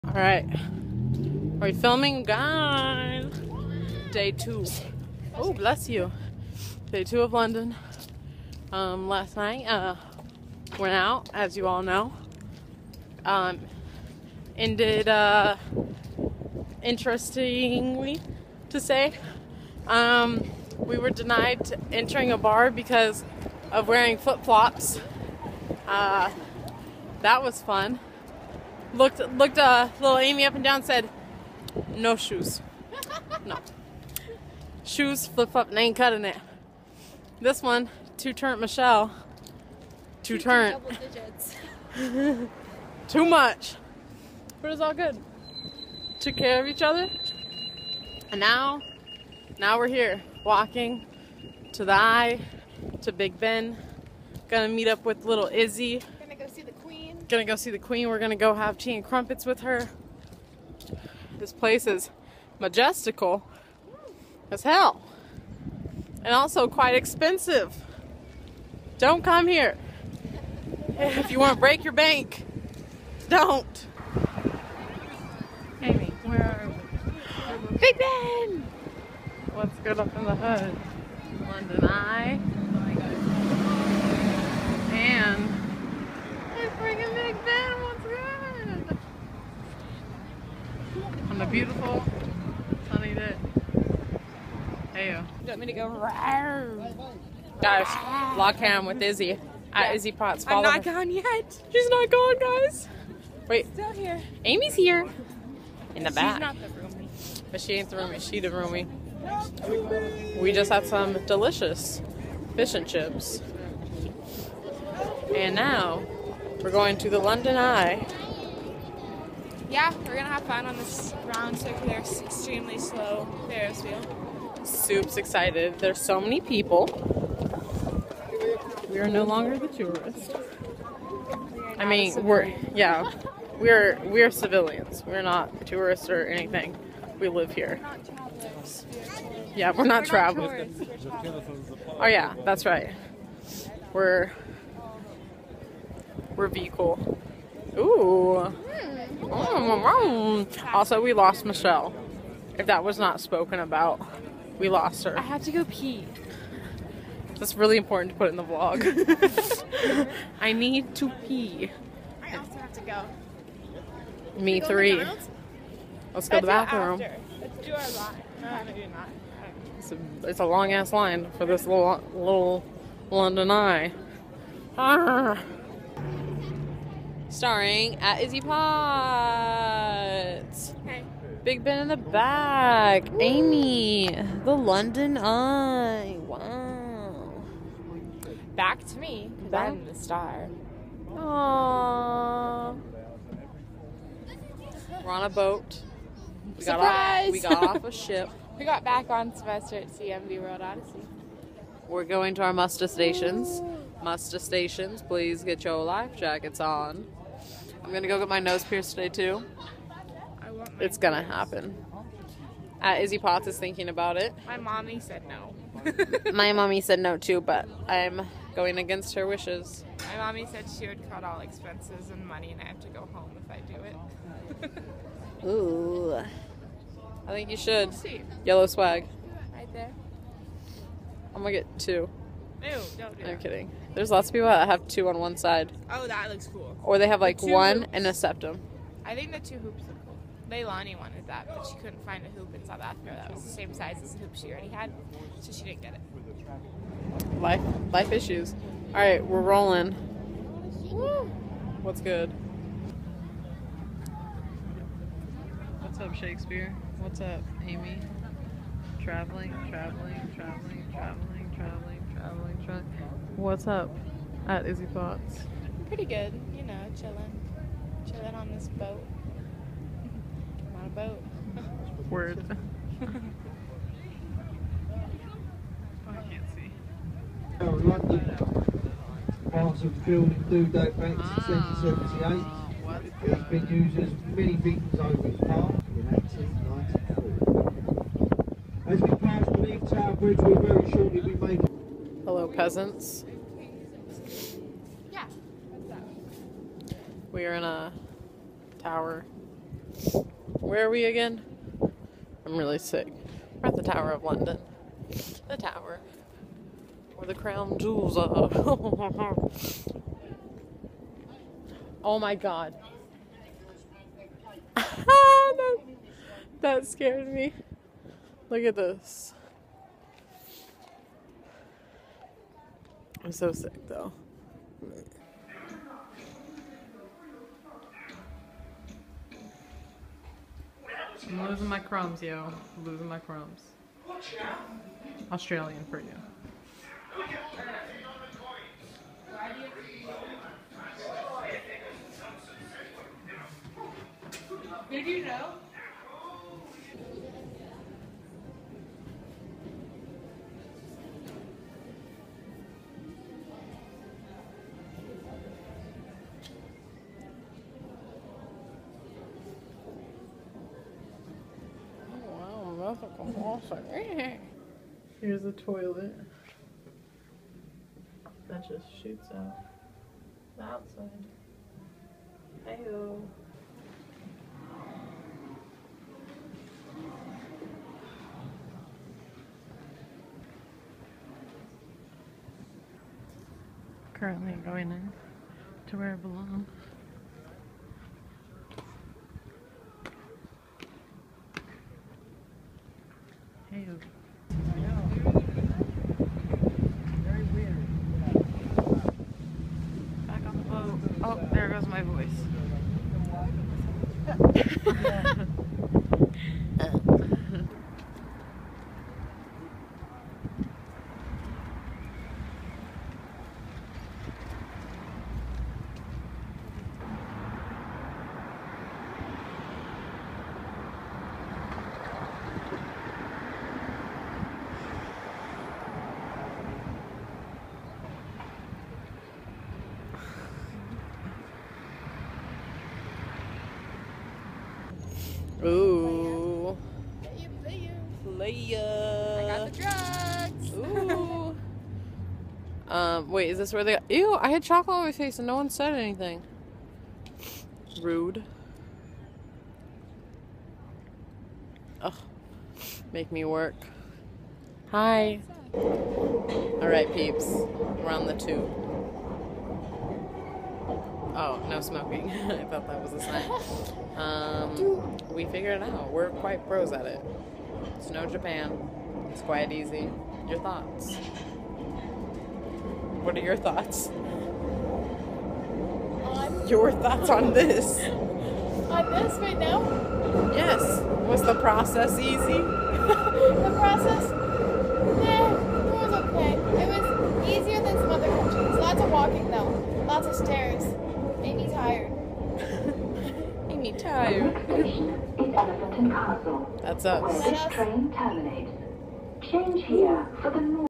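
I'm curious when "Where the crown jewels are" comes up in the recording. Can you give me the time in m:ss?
5:07.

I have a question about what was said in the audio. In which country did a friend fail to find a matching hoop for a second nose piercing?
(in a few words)
South Africa.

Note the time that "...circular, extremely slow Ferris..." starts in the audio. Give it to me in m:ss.
2:01.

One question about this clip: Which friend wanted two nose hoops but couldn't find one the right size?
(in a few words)
Leilani.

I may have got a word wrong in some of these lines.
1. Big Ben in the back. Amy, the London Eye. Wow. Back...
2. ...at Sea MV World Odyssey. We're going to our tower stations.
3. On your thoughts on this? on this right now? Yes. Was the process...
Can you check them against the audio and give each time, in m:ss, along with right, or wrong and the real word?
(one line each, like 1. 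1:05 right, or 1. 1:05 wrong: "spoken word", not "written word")
1. 3:01 right
2. 3:19 wrong: "muster", not "tower"
3. 7:56 right.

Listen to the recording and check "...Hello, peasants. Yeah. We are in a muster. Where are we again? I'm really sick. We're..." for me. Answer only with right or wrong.
wrong.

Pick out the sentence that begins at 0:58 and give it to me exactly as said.
We're gonna go have tea and crumpets with her.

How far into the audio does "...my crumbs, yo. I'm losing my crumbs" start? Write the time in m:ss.
5:31.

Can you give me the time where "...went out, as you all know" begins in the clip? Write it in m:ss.
0:10.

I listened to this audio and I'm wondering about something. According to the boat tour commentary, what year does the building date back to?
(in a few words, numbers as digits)
1778.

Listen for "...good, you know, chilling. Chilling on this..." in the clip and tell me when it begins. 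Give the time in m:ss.
4:26.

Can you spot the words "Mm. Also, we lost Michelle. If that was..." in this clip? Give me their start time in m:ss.
2:29.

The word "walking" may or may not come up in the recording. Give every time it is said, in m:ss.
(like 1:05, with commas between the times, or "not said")
0:50, 8:09.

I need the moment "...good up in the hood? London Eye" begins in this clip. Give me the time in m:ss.
1:19.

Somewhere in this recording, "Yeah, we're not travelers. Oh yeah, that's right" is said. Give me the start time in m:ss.
2:19.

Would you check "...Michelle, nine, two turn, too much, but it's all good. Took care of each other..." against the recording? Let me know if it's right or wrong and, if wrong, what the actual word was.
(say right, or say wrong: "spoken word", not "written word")
wrong: "two", not "nine".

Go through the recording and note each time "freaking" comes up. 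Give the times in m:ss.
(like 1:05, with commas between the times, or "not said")
1:26.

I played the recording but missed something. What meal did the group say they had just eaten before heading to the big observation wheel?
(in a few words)
Fish and chips.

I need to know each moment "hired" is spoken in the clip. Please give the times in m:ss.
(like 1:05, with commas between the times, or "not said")
not said.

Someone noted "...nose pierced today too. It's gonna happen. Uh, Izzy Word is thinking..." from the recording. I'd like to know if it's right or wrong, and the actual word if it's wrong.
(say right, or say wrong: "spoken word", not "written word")
wrong: "Potts", not "Word".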